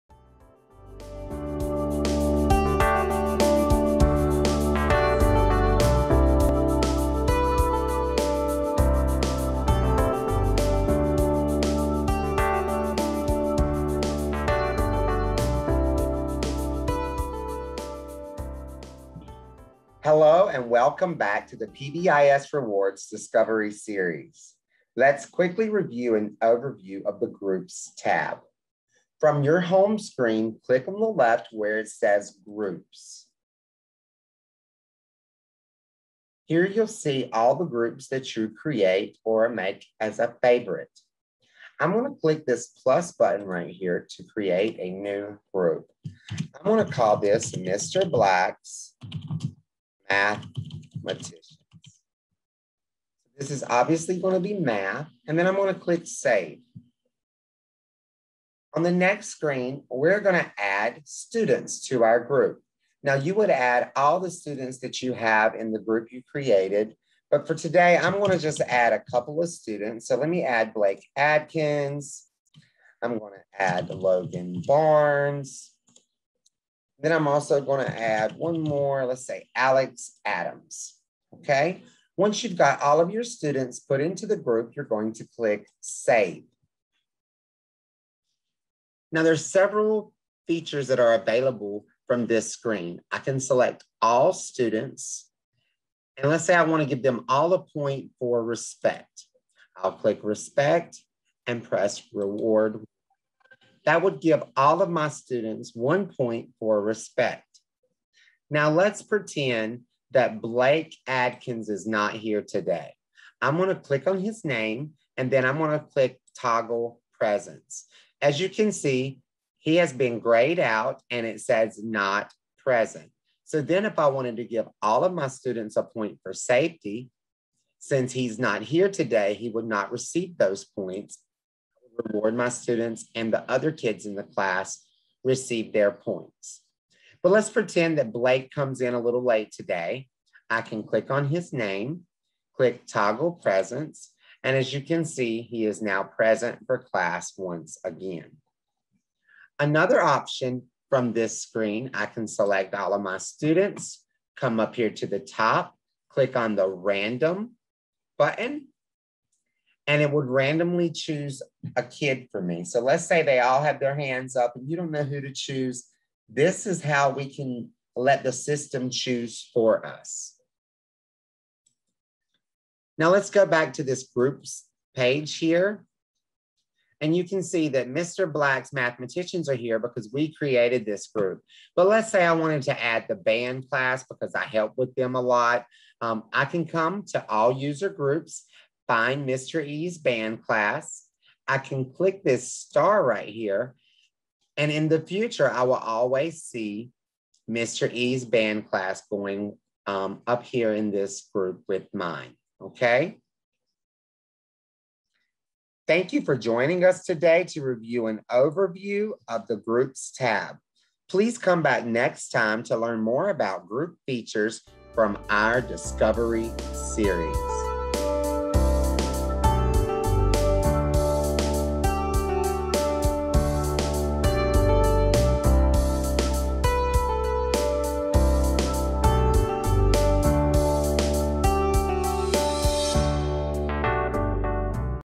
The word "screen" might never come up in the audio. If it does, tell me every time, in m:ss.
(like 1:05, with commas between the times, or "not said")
0:29, 0:59, 1:32, 2:31.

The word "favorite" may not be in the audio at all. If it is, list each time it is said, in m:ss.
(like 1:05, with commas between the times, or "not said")
0:40.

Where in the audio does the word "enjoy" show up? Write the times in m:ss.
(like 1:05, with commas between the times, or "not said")
not said.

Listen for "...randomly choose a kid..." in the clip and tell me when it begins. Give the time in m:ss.
2:40.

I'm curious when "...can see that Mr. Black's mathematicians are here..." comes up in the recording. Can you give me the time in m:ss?
2:57.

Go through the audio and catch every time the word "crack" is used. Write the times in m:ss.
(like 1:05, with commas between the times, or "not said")
not said.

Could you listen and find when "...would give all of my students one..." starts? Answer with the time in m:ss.
1:44.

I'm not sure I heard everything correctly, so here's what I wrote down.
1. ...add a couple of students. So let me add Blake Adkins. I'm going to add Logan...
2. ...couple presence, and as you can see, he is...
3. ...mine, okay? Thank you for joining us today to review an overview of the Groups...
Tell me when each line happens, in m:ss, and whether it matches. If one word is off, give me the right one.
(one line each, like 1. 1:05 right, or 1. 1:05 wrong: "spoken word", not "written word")
1. 1:08 right
2. 2:22 wrong: "toggle", not "couple"
3. 3:21 right.